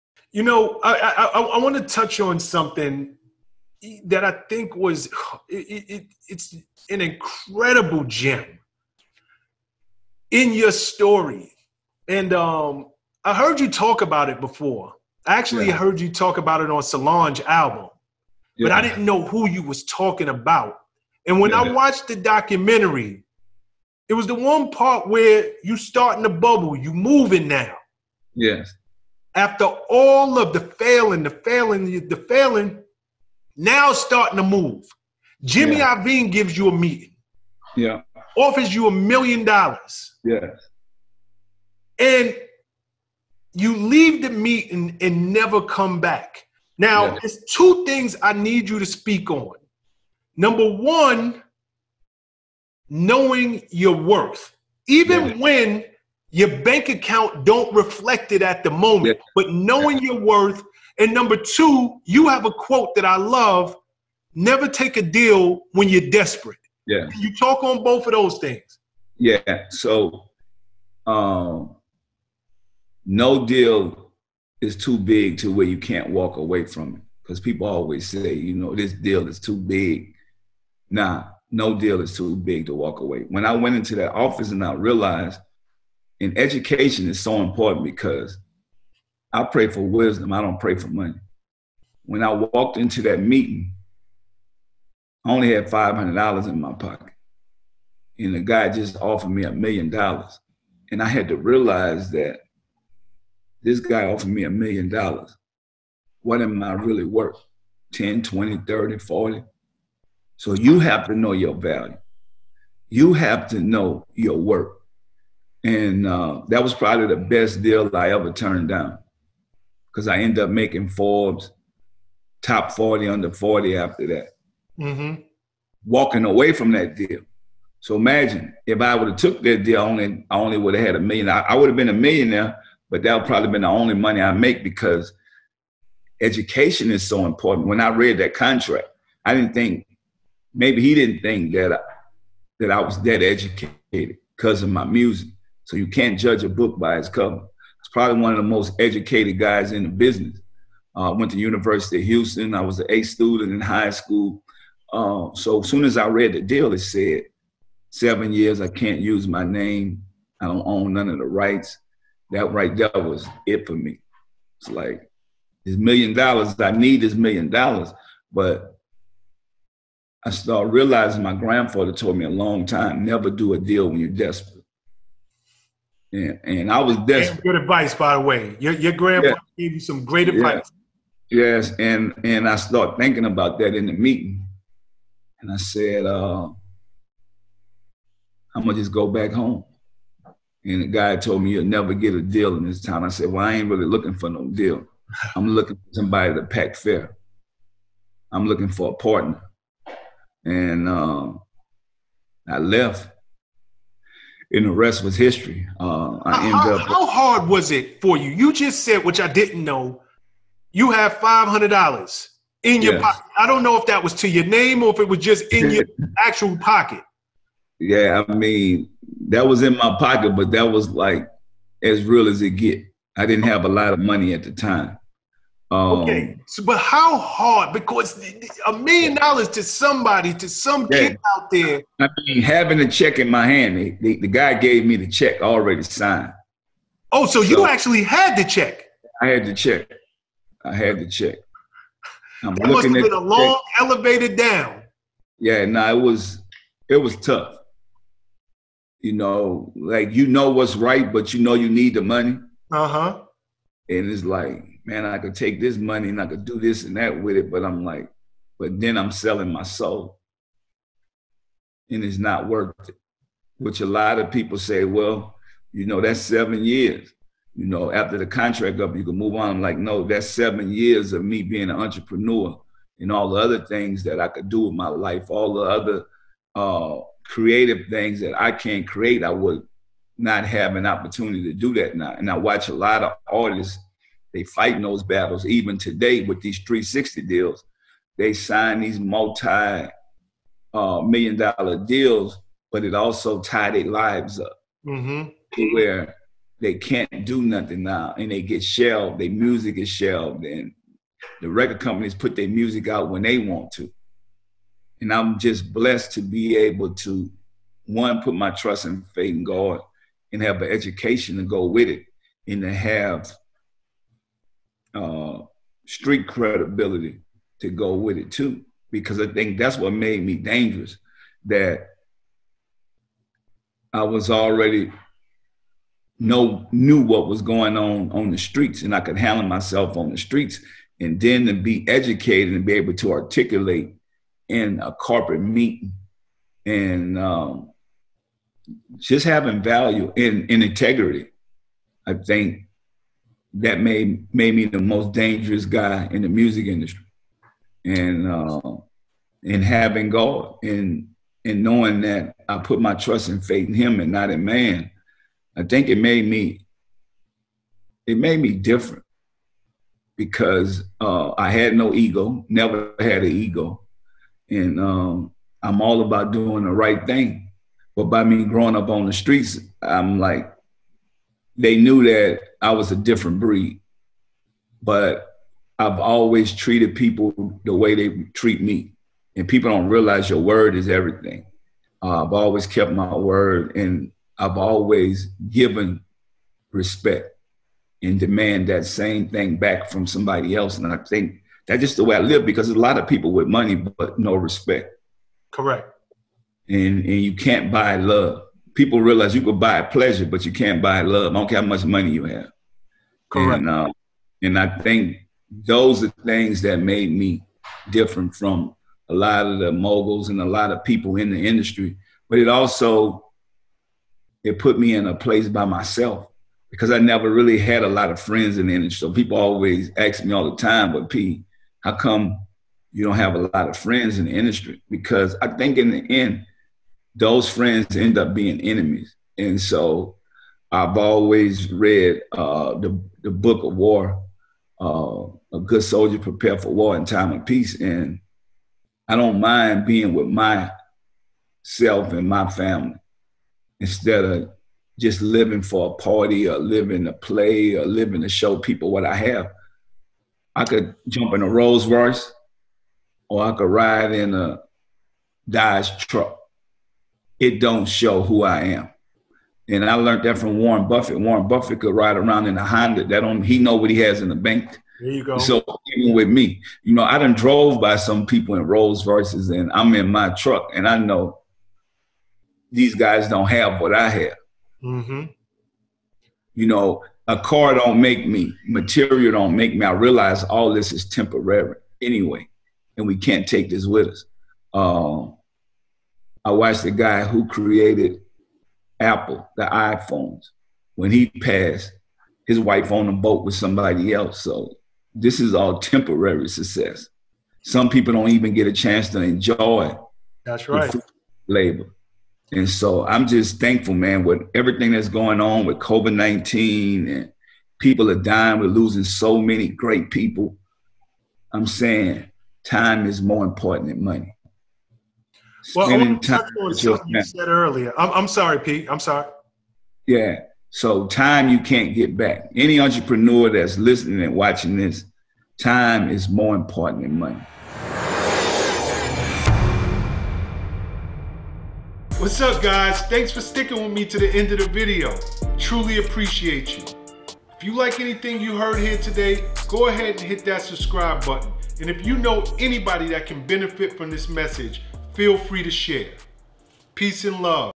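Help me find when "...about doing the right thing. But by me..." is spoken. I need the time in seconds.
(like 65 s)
366 s.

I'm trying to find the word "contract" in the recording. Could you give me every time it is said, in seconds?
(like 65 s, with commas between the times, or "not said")
138 s, 268 s.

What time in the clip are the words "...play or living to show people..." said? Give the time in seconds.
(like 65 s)
447 s.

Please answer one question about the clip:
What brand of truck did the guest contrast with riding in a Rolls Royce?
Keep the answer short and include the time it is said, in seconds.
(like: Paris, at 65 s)
Dodge, at 455 s.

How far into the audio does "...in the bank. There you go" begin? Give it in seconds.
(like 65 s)
464 s.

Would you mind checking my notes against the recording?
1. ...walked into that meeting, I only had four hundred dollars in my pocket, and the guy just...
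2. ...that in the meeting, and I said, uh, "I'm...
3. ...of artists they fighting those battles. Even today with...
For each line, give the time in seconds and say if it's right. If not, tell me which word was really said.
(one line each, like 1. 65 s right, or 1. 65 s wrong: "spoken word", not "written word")
1. 92 s wrong: "five", not "four"
2. 183 s right
3. 283 s right.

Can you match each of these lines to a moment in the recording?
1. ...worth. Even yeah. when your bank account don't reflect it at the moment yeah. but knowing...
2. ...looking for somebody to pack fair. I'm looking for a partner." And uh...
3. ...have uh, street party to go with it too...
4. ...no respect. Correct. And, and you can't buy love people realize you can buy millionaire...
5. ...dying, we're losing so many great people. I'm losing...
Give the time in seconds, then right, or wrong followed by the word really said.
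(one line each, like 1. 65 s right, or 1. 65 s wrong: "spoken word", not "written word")
1. 53 s right
2. 195 s right
3. 312 s wrong: "credibility", not "party"
4. 394 s wrong: "pleasure", not "millionaire"
5. 508 s wrong: "saying", not "losing".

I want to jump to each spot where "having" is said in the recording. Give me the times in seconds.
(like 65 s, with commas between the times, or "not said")
232 s, 339 s, 349 s.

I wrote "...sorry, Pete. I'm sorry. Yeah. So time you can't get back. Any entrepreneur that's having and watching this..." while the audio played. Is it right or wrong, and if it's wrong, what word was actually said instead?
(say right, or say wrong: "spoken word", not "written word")
wrong: "listening", not "having".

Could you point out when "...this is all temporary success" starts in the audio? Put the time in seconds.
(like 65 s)
495 s.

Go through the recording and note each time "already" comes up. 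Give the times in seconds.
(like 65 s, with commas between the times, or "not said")
235 s, 324 s.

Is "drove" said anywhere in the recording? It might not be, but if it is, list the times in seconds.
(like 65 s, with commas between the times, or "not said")
467 s.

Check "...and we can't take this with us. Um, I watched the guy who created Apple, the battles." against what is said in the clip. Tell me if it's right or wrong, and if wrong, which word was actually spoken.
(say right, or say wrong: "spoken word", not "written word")
wrong: "iPhones", not "battles".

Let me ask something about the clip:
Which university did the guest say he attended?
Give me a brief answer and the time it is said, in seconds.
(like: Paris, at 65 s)
University of Houston, at 151 s.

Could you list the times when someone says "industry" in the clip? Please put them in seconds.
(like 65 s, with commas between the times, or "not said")
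346 s, 411 s, 418 s, 424 s.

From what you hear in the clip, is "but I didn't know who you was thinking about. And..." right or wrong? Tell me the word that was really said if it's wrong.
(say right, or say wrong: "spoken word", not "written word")
wrong: "talking", not "thinking".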